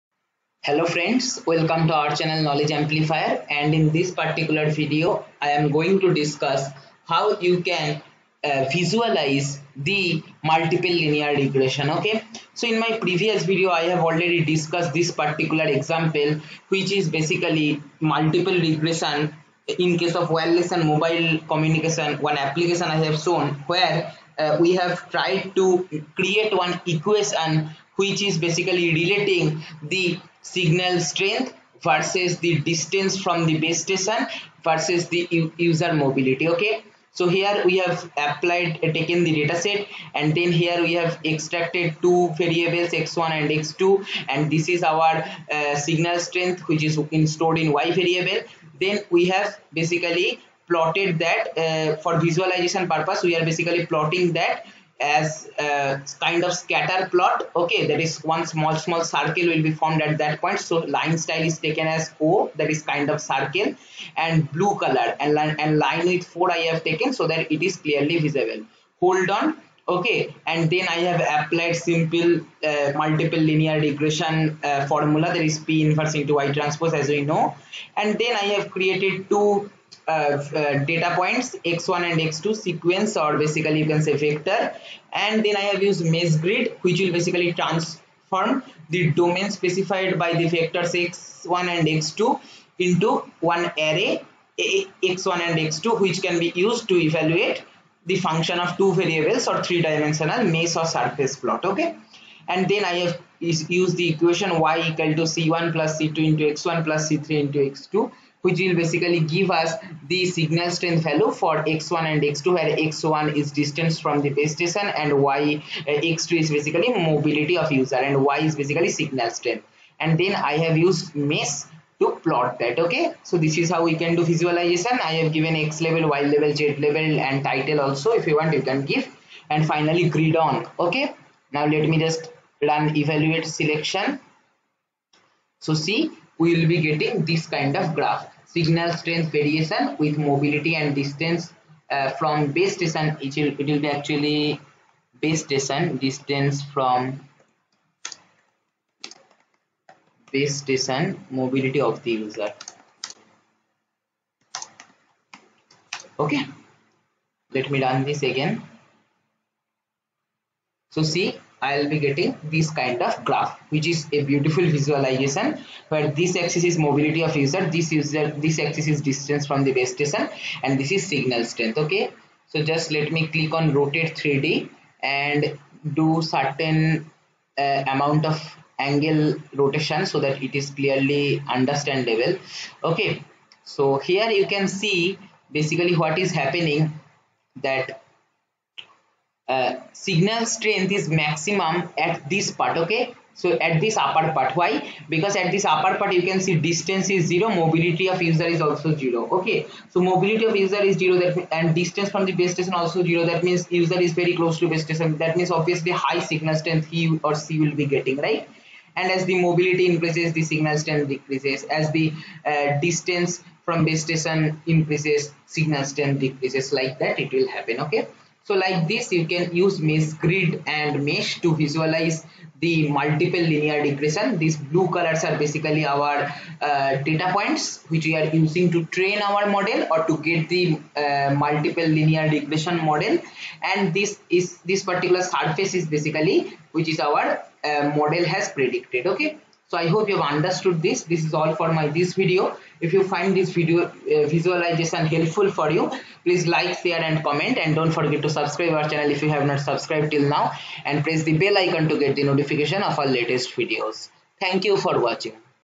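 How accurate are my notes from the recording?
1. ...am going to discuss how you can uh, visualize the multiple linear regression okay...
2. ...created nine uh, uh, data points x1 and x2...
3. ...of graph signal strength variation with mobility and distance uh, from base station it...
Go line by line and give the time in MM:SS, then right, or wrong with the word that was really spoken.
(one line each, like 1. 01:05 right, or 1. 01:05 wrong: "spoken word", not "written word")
1. 00:05 right
2. 01:18 wrong: "two", not "nine"
3. 02:17 right.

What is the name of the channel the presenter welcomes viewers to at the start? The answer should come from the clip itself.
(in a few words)
Knowledge Amplifier.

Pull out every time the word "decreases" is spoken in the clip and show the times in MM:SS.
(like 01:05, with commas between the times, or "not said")
03:31, 03:36.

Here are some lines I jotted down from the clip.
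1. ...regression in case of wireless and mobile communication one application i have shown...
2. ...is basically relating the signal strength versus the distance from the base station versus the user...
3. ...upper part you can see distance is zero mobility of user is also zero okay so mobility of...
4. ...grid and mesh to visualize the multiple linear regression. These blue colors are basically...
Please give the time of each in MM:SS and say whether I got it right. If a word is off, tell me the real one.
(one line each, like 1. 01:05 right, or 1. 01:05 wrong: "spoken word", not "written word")
1. 00:18 right
2. 00:28 right
3. 03:15 right
4. 03:40 right.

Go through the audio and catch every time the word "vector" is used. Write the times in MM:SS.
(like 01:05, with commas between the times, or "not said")
01:24, 01:30.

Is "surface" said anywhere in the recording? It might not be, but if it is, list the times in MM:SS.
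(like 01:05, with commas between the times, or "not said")
01:40, 03:55.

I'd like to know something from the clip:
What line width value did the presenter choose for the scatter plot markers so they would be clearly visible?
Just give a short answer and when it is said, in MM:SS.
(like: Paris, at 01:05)
4, at 01:06.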